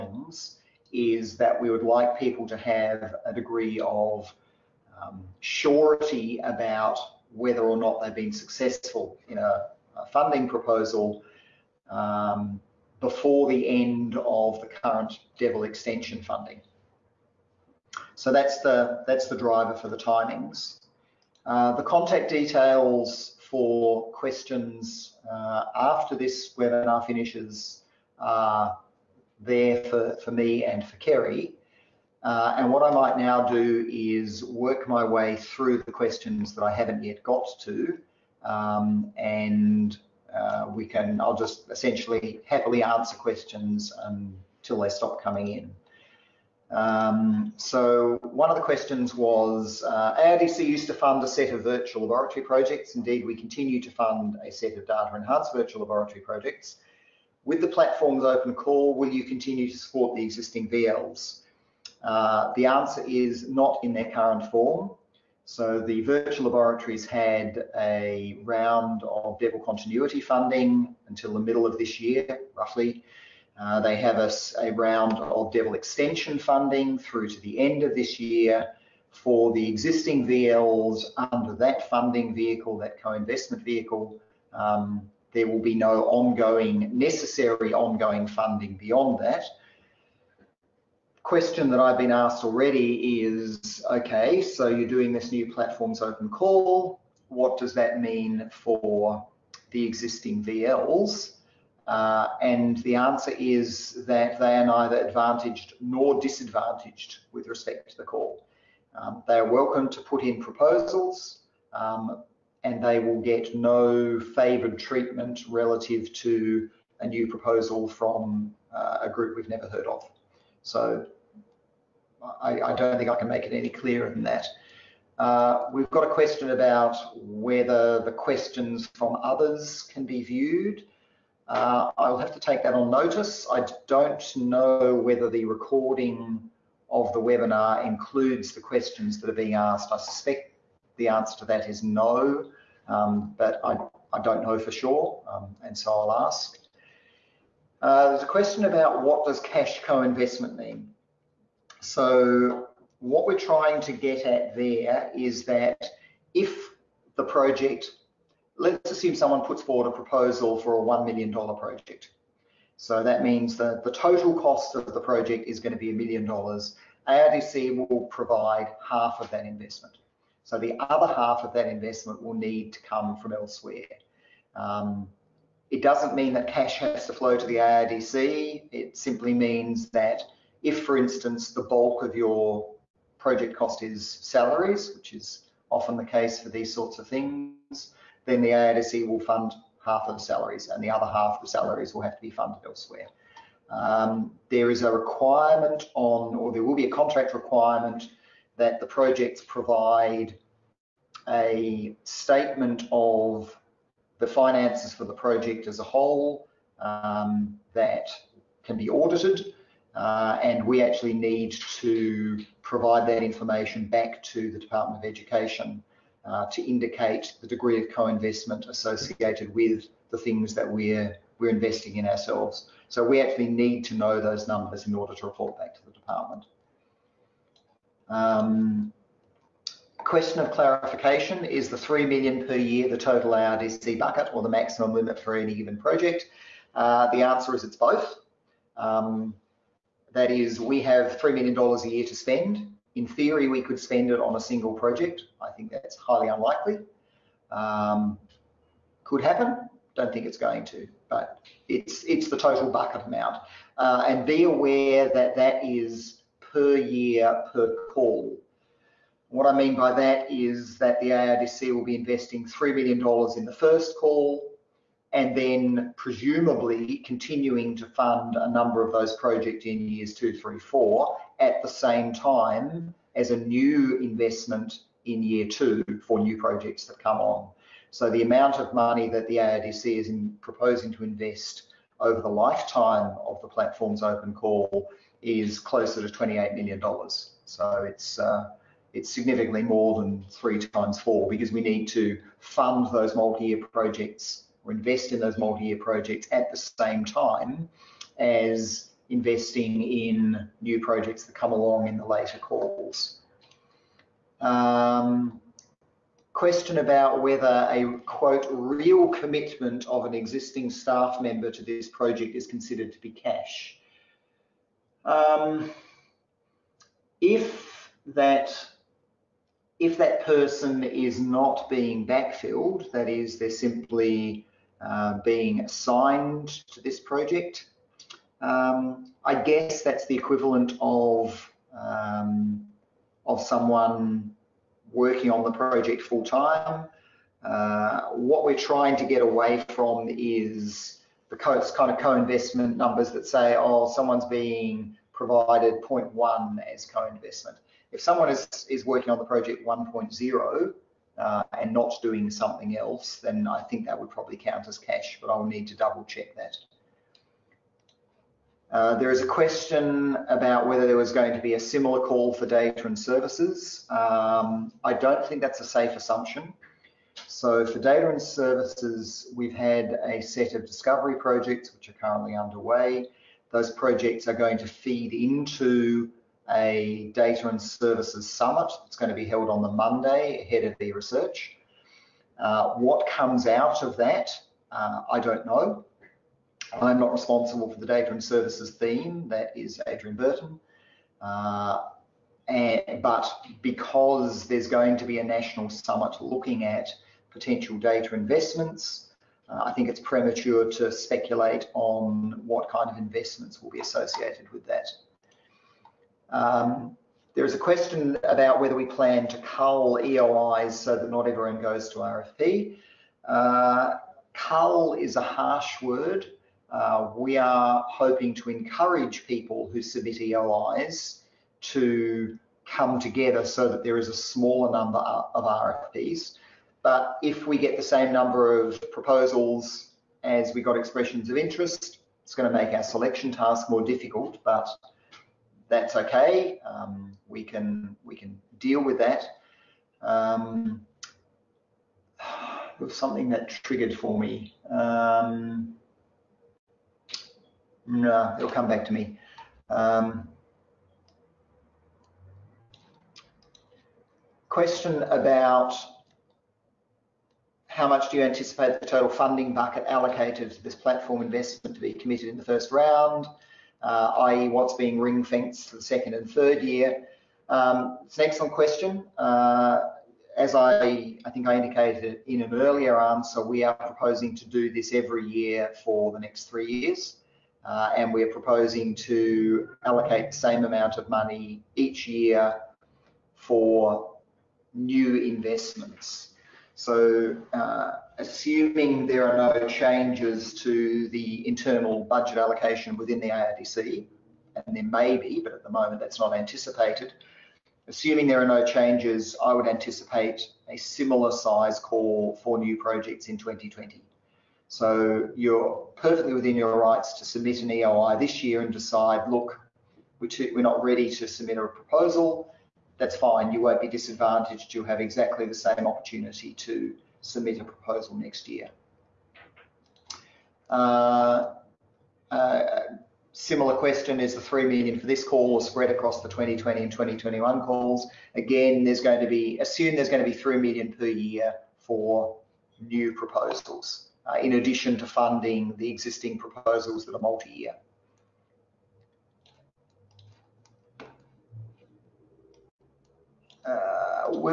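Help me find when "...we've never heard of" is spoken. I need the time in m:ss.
1:59.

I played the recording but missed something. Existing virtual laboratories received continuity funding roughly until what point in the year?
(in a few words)
middle of this year.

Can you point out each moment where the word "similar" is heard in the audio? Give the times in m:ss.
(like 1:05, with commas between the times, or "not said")
6:01, 8:20, 8:43.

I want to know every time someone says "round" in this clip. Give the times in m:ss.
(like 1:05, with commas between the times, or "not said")
1:08, 1:14, 7:42.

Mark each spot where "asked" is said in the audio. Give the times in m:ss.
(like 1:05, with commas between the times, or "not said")
1:32, 2:19.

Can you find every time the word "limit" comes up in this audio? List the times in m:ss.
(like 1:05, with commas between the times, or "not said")
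3:54.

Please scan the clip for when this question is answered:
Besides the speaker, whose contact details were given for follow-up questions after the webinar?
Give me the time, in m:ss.
0:30.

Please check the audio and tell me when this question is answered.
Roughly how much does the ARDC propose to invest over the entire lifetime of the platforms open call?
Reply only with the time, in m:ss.
4:46.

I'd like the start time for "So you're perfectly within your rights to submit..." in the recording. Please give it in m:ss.
8:24.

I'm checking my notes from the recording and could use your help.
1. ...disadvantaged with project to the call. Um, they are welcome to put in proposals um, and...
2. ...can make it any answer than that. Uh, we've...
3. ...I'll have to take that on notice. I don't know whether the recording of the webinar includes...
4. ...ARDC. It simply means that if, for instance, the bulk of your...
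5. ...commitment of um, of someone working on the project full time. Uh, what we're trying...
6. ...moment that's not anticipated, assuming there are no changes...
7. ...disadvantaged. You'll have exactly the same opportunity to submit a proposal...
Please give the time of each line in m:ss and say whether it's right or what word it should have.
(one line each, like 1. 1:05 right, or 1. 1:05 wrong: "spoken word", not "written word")
1. 1:46 wrong: "respect", not "project"
2. 2:03 wrong: "clearer", not "answer"
3. 2:11 right
4. 2:57 right
5. 5:30 wrong: "equivalent", not "commitment"
6. 8:15 right
7. 8:33 right.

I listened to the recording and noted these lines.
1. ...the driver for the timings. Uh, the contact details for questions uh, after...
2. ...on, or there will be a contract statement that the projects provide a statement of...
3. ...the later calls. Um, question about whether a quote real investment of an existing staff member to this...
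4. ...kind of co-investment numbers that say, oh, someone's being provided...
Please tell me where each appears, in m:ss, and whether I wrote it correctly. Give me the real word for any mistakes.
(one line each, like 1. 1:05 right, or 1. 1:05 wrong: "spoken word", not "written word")
1. 0:19 right
2. 3:15 wrong: "requirement", not "statement"
3. 5:01 wrong: "commitment", not "investment"
4. 5:41 right.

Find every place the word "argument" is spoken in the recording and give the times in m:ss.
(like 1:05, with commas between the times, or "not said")
not said.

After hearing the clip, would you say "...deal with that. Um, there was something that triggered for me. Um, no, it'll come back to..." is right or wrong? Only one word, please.
right.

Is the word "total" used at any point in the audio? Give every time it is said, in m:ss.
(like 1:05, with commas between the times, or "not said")
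2:43, 3:52, 4:12, 7:38.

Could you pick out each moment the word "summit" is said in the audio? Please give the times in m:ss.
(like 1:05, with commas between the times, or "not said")
6:18, 6:35.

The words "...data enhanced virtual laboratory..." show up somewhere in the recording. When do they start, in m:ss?
0:54.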